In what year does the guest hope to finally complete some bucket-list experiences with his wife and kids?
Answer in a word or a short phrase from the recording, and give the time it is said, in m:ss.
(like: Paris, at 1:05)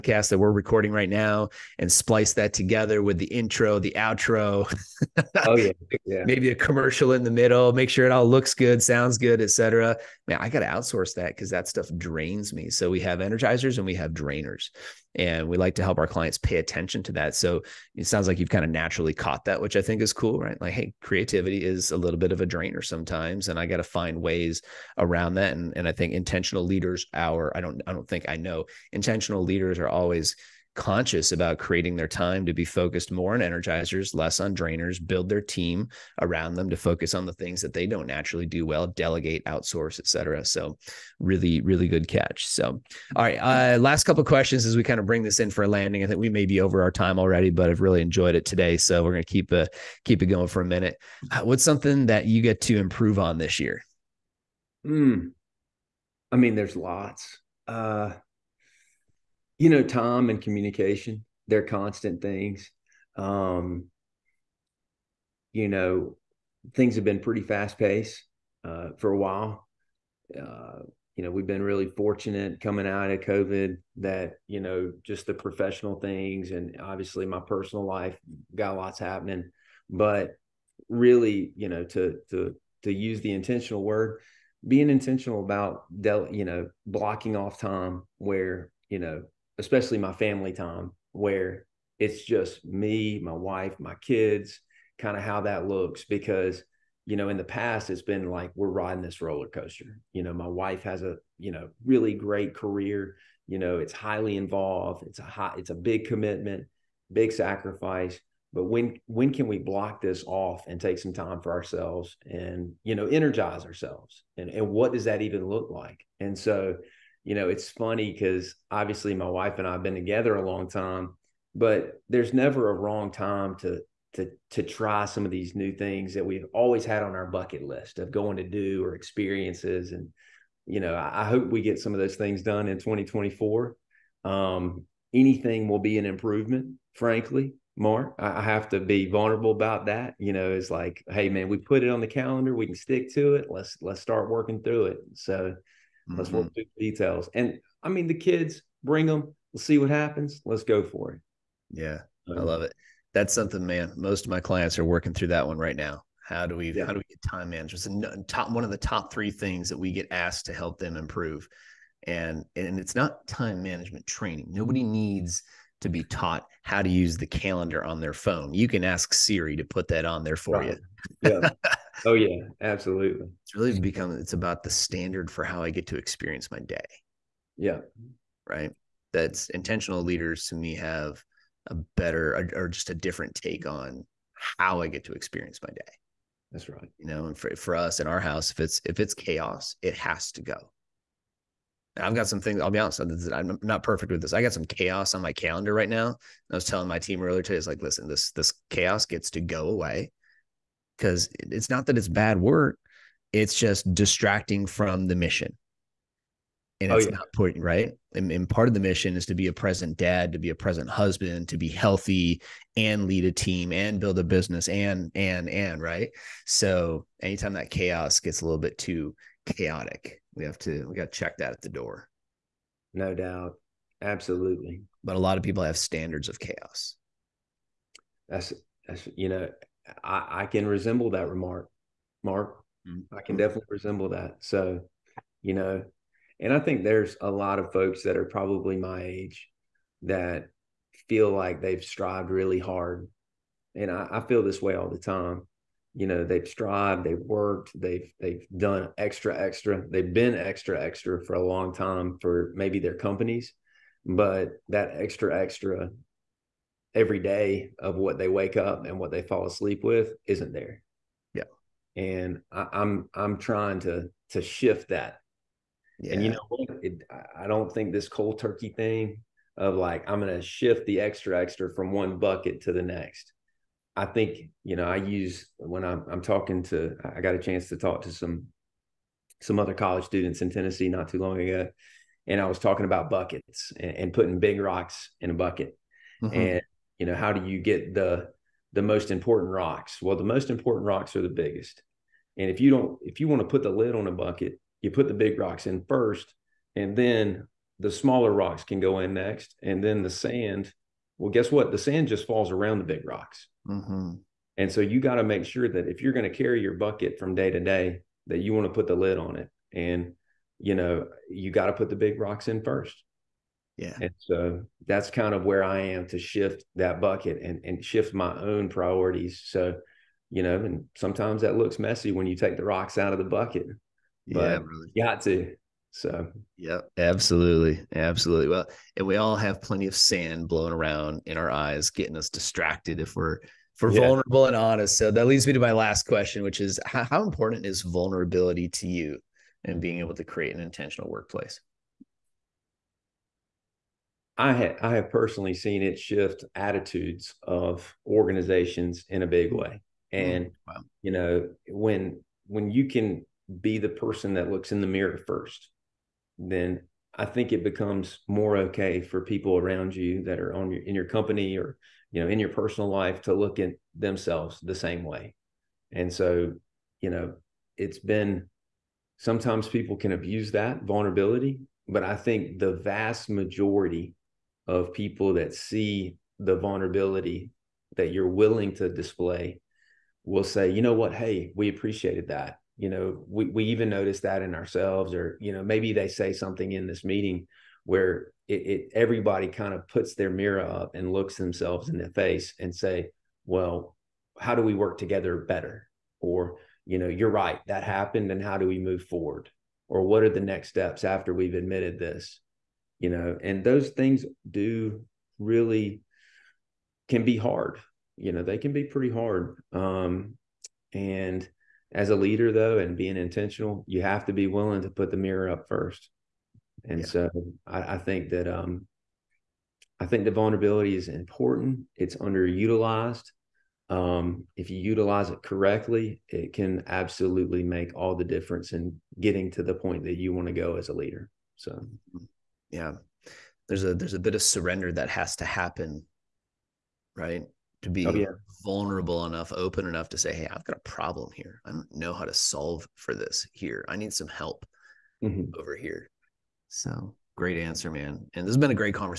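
2024, at 2:12.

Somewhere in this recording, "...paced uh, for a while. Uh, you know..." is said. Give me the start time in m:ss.
1:07.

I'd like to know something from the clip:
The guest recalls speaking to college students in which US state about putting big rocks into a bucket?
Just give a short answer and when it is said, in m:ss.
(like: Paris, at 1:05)
Tennessee, at 4:40.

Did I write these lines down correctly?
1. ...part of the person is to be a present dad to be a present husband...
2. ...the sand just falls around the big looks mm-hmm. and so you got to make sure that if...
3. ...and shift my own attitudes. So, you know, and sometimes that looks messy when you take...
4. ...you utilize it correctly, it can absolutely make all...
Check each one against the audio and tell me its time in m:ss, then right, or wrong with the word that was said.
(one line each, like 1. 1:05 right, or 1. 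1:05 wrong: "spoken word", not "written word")
1. 3:28 wrong: "mission", not "person"
2. 5:01 wrong: "rocks", not "looks"
3. 5:17 wrong: "priorities", not "attitudes"
4. 7:04 right.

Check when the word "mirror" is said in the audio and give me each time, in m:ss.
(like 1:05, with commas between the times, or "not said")
5:54, 6:30, 6:55.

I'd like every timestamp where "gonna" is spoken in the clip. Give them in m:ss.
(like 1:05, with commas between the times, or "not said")
0:49, 4:30.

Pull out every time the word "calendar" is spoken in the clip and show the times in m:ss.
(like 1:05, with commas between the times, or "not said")
2:22, 2:47, 3:15.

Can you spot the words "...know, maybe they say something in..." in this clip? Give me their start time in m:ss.
6:25.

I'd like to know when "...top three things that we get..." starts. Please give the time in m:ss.
2:38.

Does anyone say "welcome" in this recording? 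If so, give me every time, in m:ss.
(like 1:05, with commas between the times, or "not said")
not said.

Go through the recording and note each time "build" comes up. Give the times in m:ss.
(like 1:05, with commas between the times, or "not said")
0:35, 3:34.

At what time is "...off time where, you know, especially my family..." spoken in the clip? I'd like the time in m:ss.
1:27.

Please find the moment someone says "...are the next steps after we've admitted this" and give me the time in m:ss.
6:40.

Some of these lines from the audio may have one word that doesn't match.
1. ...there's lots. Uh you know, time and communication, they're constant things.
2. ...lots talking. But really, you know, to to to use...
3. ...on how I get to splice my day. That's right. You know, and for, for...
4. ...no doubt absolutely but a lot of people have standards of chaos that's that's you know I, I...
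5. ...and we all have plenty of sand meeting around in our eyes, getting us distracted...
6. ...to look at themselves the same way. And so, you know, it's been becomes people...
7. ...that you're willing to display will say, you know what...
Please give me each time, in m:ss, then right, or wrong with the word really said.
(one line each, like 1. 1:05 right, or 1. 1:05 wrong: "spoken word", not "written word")
1. 0:56 right
2. 1:18 wrong: "happening", not "talking"
3. 3:03 wrong: "experience", not "splice"
4. 3:42 right
5. 5:28 wrong: "blowing", not "meeting"
6. 6:03 wrong: "sometimes", not "becomes"
7. 6:17 right.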